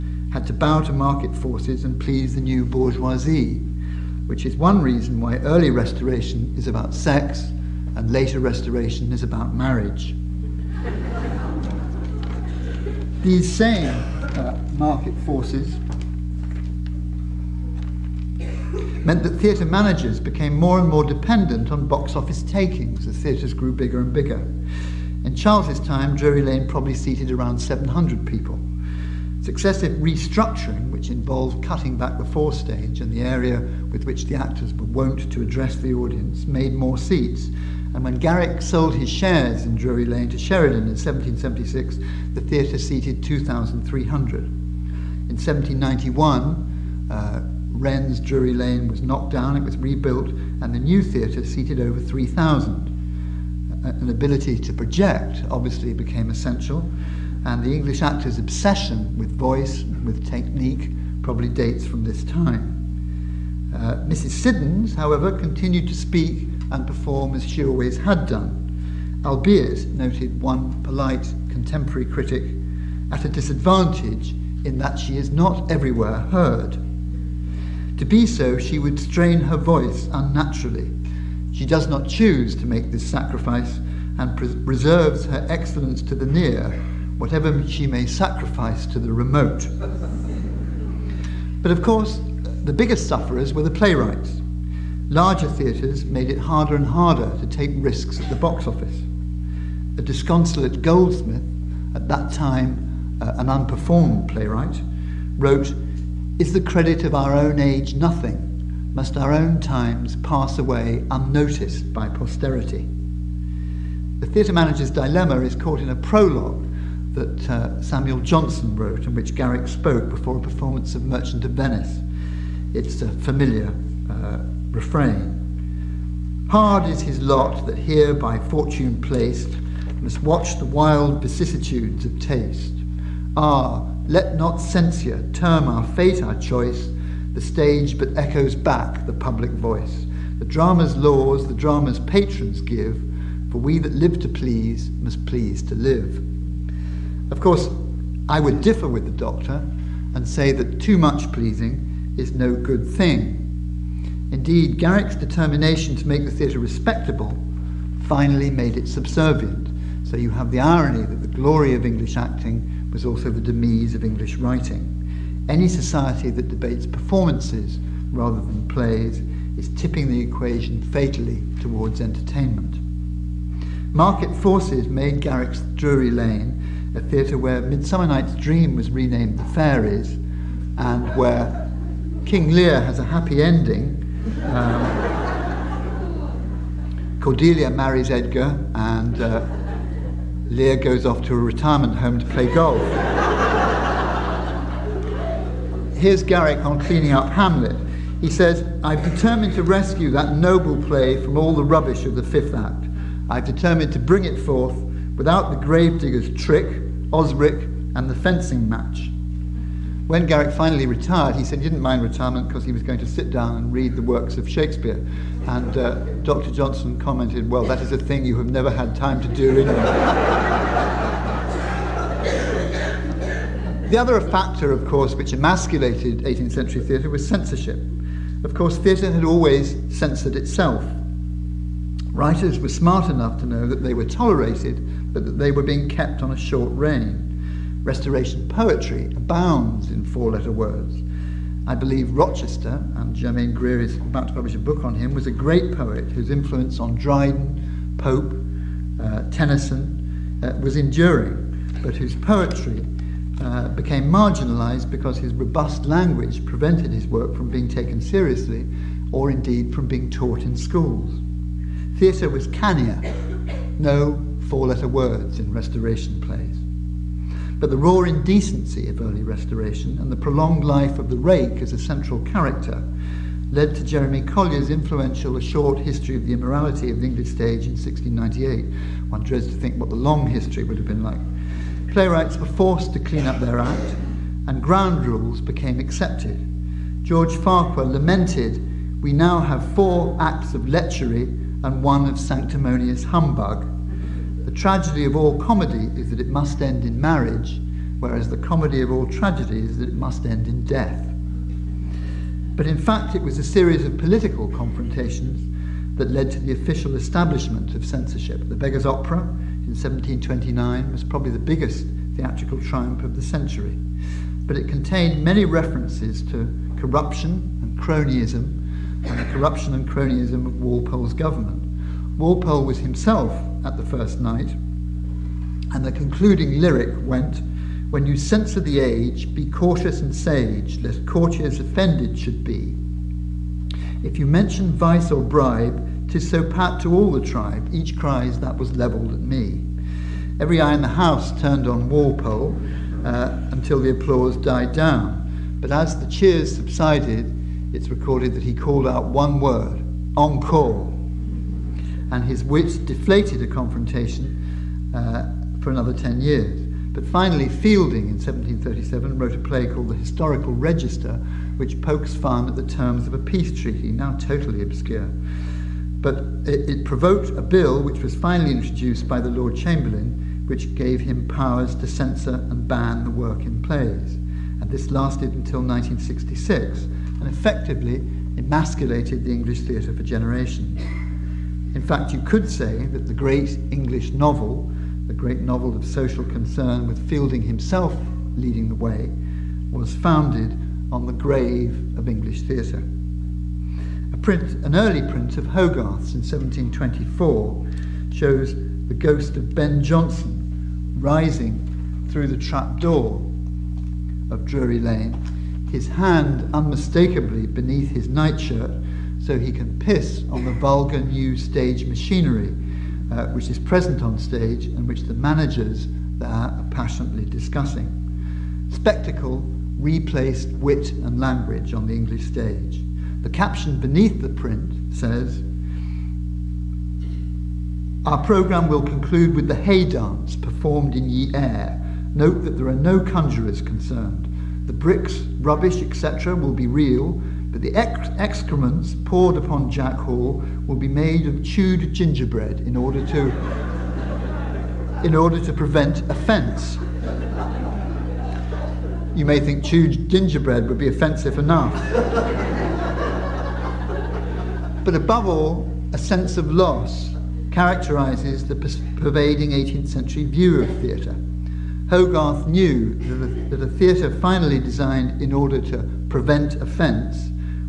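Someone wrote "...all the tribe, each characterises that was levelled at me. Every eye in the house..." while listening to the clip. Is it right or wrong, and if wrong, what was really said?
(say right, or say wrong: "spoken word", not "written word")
wrong: "cries", not "characterises".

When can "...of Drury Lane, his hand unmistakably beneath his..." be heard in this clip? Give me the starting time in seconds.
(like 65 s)
404 s.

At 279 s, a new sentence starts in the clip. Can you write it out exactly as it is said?
One dreads to think what the long history would have been like.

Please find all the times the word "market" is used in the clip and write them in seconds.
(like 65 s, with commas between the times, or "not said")
0 s, 14 s, 173 s.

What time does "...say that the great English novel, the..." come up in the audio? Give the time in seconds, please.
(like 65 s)
382 s.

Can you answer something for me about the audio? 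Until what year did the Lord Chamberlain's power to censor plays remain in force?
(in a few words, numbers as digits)
1966.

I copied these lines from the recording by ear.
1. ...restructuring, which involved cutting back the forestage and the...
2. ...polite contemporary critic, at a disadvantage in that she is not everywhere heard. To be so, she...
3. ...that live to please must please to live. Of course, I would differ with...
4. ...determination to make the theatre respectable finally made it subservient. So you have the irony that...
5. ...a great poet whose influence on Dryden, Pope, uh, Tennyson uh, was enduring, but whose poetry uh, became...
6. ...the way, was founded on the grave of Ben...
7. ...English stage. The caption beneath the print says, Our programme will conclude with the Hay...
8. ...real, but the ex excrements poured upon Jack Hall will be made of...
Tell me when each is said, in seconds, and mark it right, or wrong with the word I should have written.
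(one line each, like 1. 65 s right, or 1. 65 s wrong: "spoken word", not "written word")
1. 29 s right
2. 70 s right
3. 143 s right
4. 155 s right
5. 245 s right
6. 388 s wrong: "English", not "Ben"
7. 421 s right
8. 436 s right.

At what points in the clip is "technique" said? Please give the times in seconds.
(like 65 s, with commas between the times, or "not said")
60 s.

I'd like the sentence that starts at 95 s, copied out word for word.
Larger theatres made it harder and harder to take risks at the box office.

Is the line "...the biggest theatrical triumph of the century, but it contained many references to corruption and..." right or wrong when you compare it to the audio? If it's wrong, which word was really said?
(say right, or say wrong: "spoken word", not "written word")
right.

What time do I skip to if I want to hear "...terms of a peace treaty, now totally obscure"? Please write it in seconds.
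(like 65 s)
362 s.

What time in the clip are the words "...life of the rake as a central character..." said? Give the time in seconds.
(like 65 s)
270 s.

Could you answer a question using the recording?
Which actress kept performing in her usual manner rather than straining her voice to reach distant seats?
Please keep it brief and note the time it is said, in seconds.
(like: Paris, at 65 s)
Mrs. Siddons, at 64 s.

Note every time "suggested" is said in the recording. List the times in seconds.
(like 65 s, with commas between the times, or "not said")
not said.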